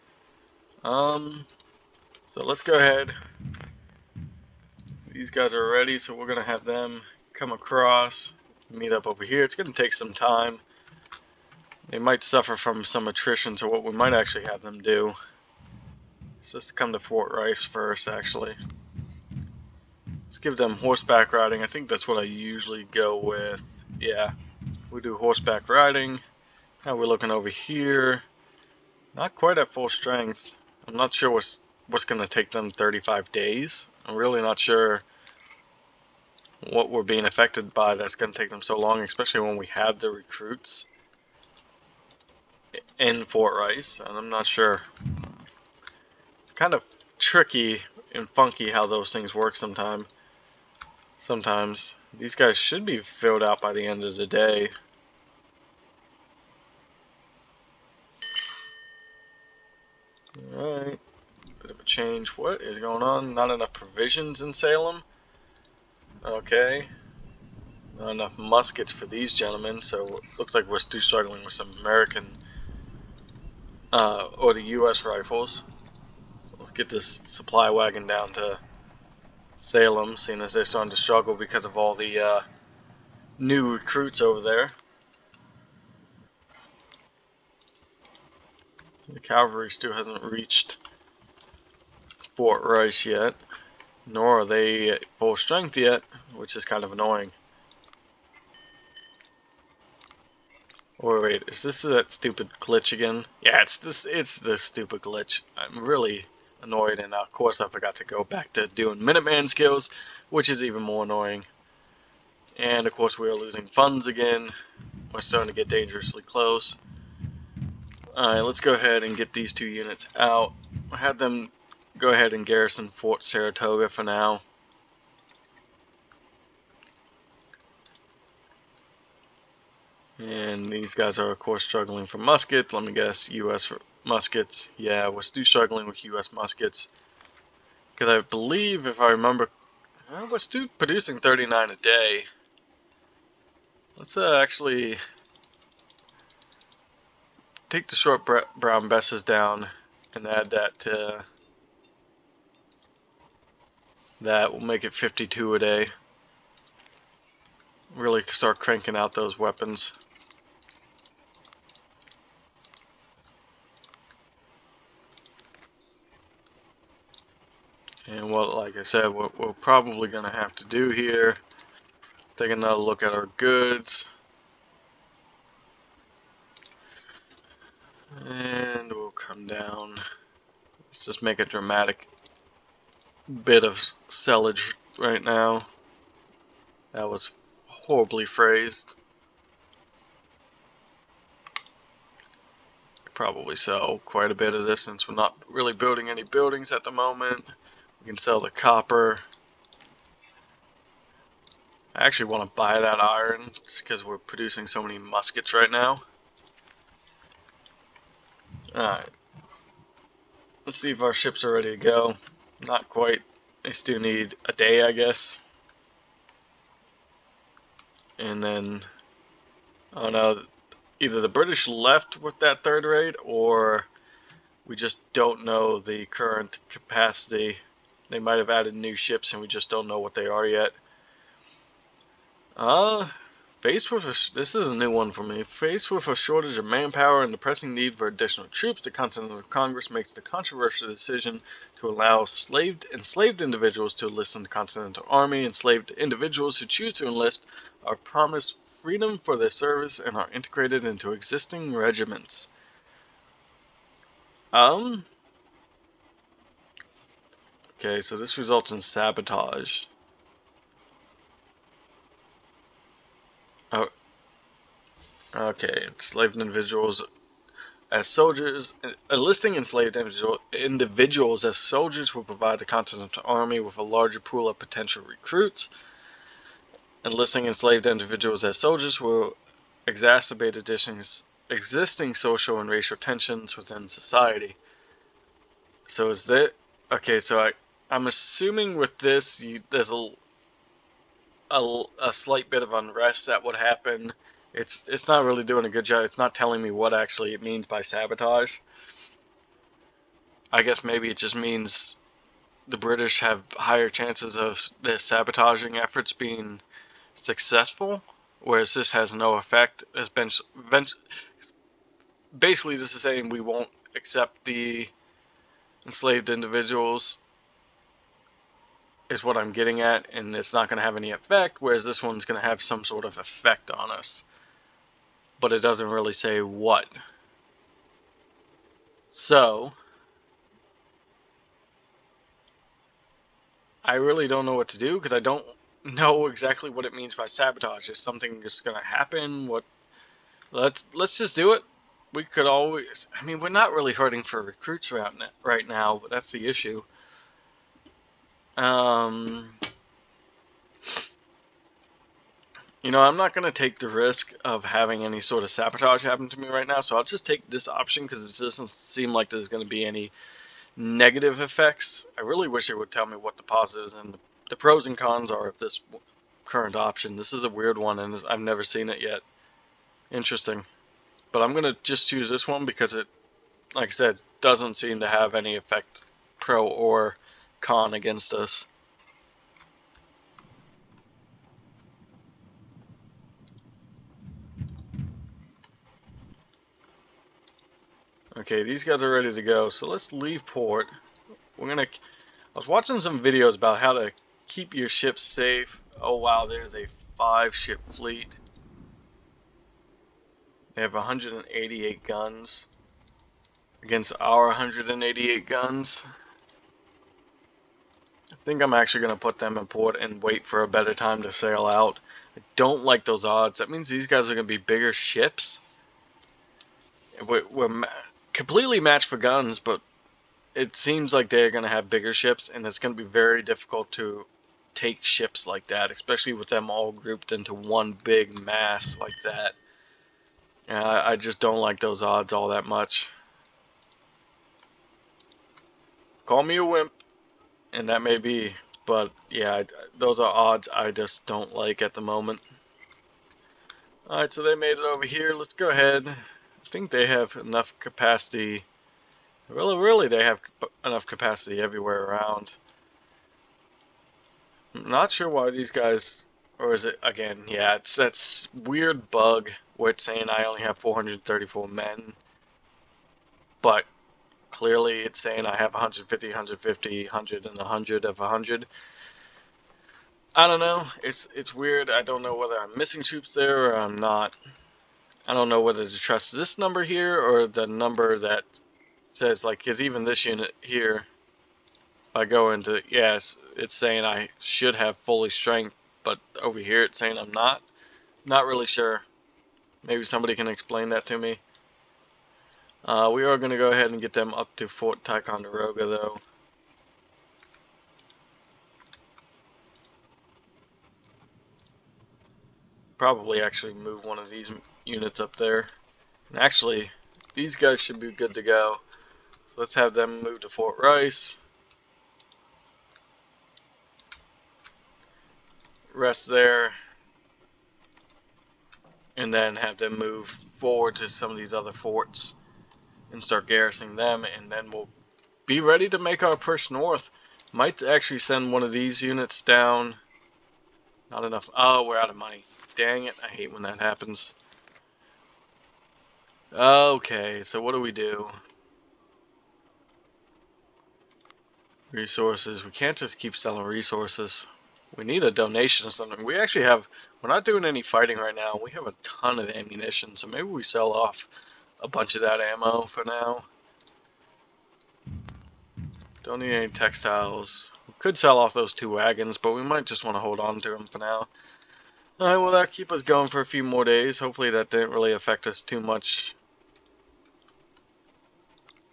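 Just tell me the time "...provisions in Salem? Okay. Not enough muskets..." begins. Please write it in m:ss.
1:03.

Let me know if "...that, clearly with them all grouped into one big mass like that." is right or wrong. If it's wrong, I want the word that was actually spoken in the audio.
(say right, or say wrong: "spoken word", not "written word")
wrong: "especially", not "clearly".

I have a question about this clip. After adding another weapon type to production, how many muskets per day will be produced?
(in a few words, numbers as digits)
52.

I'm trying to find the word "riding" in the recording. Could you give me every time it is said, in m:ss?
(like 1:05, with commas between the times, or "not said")
0:21, 0:25.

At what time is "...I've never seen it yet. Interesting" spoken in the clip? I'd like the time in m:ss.
6:08.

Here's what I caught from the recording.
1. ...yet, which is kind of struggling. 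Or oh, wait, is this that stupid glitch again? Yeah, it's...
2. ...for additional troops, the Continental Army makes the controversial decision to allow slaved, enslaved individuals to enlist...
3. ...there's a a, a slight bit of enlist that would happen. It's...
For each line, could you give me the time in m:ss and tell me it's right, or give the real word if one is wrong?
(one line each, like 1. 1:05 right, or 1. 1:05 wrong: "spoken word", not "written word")
1. 1:35 wrong: "annoying", not "struggling"
2. 3:57 wrong: "Congress", not "Army"
3. 4:49 wrong: "unrest", not "enlist".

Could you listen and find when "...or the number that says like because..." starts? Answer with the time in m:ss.
7:57.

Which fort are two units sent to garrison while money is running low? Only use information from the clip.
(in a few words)
Fort Saratoga.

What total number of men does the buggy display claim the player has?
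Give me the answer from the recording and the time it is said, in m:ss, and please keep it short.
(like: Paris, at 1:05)
434, at 7:40.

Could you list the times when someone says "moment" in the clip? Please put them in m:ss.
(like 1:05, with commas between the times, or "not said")
3:16, 7:22.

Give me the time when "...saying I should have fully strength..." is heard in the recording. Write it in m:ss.
8:03.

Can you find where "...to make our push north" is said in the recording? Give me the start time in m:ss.
8:45.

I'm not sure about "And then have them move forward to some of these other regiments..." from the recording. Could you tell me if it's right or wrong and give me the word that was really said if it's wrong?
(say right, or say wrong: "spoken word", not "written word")
wrong: "forts", not "regiments".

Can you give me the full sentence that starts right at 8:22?
Probably actually move one of these units up there.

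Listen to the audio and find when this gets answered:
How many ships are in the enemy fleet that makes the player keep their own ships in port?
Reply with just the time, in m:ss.
6:37.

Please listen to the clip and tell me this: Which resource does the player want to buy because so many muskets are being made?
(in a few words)
Iron.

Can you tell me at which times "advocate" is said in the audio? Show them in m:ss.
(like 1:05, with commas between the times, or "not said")
not said.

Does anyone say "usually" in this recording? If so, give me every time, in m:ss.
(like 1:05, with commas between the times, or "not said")
0:22.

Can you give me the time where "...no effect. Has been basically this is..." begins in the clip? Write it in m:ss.
5:09.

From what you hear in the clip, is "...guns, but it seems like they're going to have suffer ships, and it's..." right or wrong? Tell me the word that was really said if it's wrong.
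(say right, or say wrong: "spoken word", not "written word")
wrong: "bigger", not "suffer".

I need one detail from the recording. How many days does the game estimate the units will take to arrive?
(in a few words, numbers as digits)
35.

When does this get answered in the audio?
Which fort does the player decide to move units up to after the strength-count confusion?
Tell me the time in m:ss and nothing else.
8:14.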